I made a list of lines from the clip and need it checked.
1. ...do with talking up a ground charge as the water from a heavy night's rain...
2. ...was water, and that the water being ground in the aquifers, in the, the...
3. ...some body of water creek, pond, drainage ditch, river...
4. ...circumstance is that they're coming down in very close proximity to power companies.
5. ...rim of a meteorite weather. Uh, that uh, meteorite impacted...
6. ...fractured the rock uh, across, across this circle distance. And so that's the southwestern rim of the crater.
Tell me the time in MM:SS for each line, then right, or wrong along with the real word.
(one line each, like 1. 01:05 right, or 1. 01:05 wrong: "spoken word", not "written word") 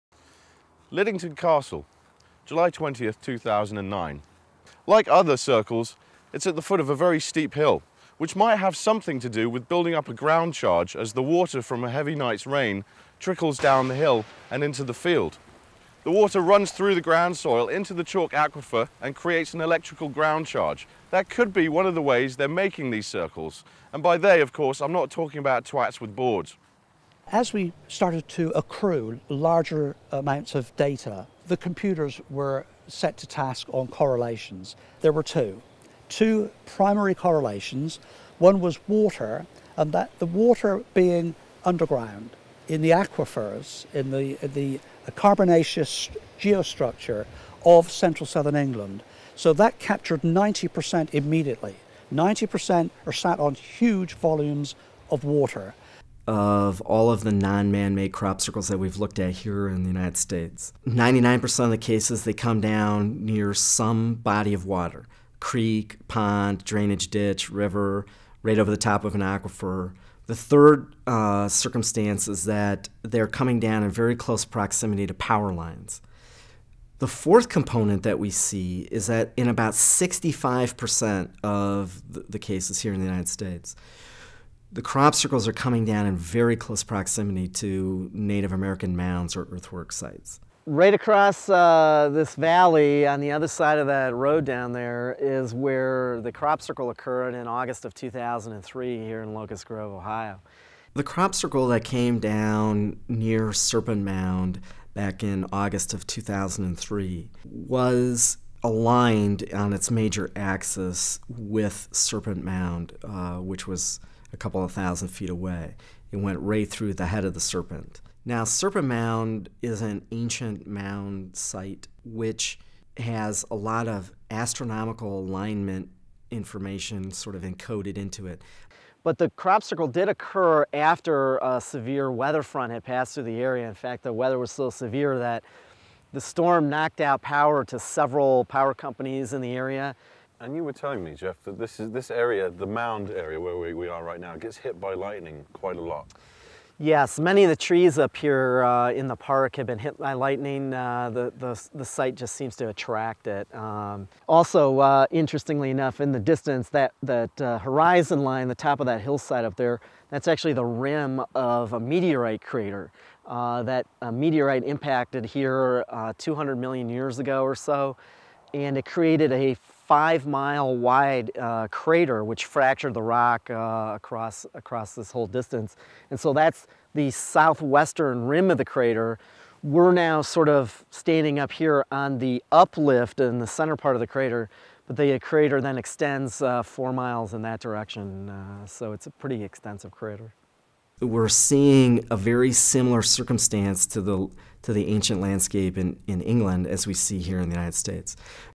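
1. 00:09 wrong: "building", not "talking"
2. 00:38 wrong: "underground", not "ground"
3. 01:03 right
4. 01:11 wrong: "lines", not "companies"
5. 02:40 wrong: "crater", not "weather"
6. 02:52 wrong: "whole", not "circle".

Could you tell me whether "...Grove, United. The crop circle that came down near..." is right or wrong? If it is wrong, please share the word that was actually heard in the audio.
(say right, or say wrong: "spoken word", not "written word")
wrong: "Ohio", not "United".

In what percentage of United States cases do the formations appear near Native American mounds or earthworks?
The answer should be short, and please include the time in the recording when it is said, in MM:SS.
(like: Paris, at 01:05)
65%, at 01:19.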